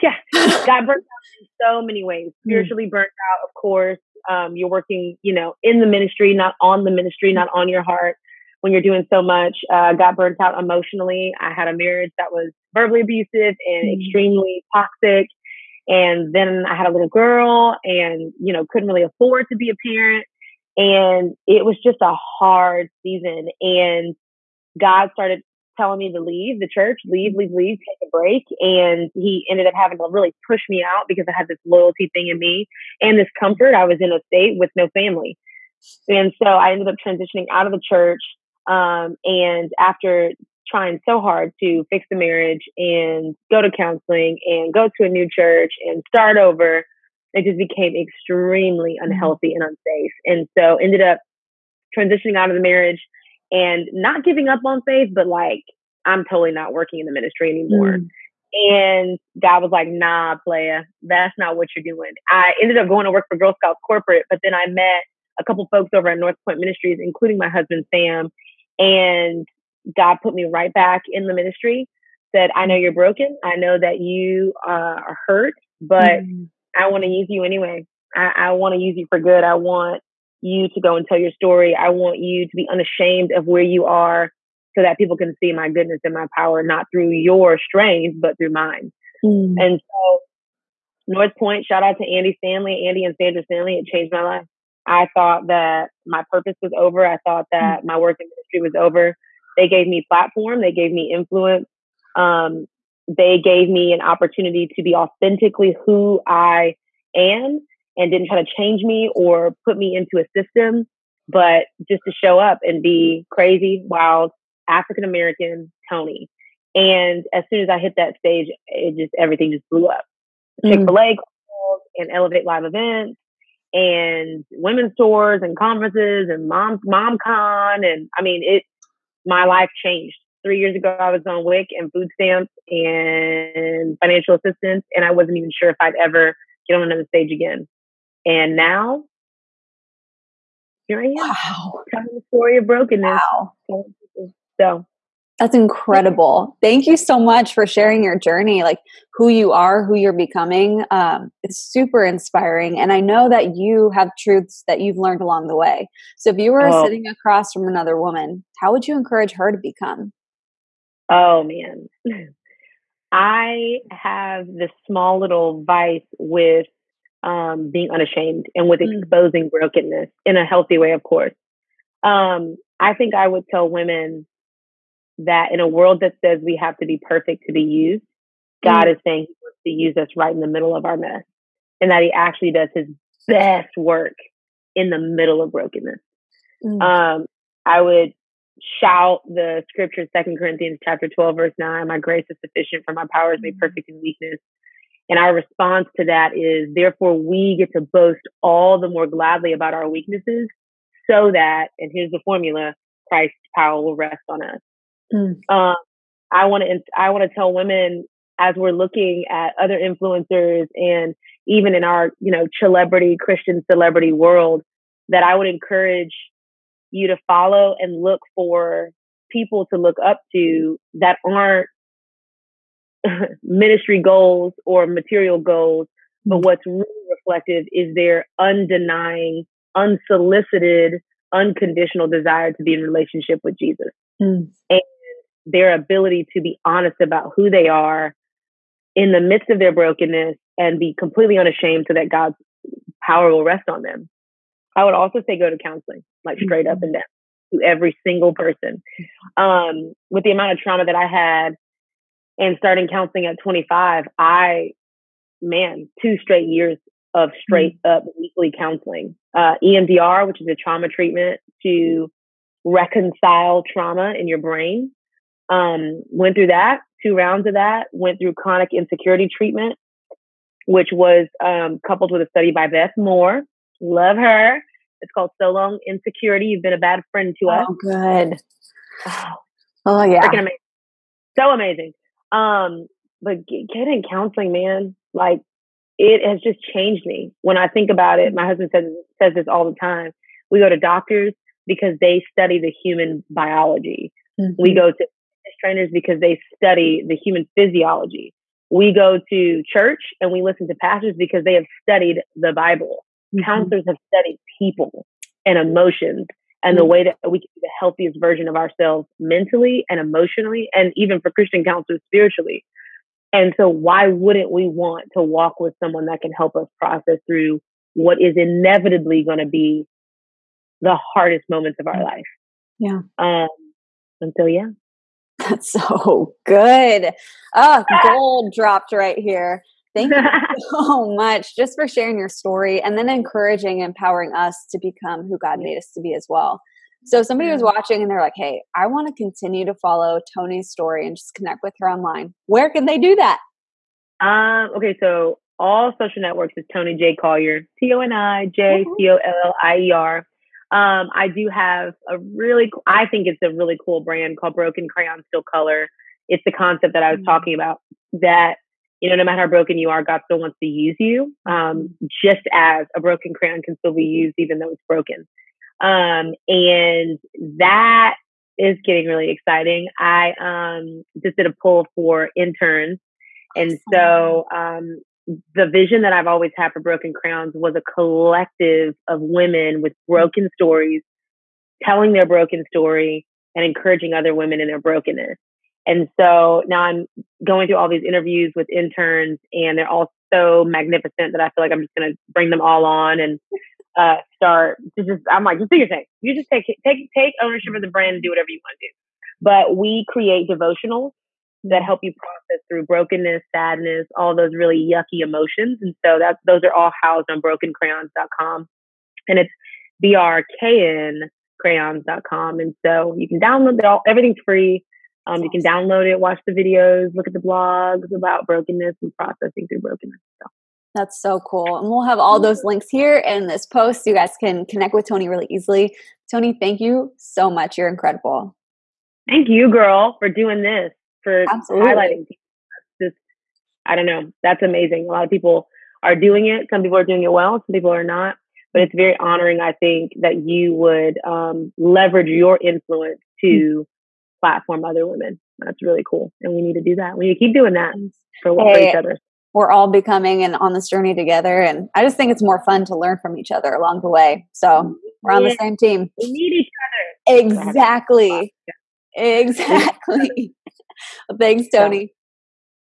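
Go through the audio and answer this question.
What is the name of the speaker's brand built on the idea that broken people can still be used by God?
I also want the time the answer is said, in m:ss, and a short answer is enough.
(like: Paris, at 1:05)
Broken Crayon Still Color, at 5:54.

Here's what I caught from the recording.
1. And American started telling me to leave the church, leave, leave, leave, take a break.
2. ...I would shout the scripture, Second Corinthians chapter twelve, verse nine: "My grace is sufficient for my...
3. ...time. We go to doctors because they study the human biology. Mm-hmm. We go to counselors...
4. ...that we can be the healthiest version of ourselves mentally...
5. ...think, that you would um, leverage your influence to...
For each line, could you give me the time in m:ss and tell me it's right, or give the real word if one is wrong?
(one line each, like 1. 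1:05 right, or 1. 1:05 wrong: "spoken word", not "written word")
1. 0:23 wrong: "God", not "American"
2. 3:07 right
3. 4:49 wrong: "trainers", not "counselors"
4. 5:07 right
5. 7:19 right.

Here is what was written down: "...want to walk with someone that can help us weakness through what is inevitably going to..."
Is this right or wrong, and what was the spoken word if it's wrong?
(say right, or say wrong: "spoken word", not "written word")
wrong: "process", not "weakness".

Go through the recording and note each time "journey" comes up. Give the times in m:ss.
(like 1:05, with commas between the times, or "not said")
2:28, 7:30.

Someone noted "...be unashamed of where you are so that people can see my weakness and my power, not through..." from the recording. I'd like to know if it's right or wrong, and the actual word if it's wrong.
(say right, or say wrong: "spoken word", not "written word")
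wrong: "goodness", not "weakness".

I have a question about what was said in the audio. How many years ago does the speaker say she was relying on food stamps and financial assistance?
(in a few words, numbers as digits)
3.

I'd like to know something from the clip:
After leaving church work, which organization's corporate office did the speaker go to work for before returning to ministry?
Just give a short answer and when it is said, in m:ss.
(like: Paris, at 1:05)
Girl Scouts, at 1:03.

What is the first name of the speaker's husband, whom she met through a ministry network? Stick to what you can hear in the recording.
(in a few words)
Sam.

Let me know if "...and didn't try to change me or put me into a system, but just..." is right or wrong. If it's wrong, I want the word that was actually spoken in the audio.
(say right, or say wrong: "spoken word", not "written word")
right.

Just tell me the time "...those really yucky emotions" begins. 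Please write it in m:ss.
6:44.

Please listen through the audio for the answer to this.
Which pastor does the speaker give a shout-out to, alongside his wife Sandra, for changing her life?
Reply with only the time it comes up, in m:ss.
1:32.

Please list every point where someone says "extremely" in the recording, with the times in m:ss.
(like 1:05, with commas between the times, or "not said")
0:14, 0:47.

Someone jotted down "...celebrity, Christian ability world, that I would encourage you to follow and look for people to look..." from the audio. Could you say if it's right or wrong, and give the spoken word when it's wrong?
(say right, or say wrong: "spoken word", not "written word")
wrong: "celebrity", not "ability".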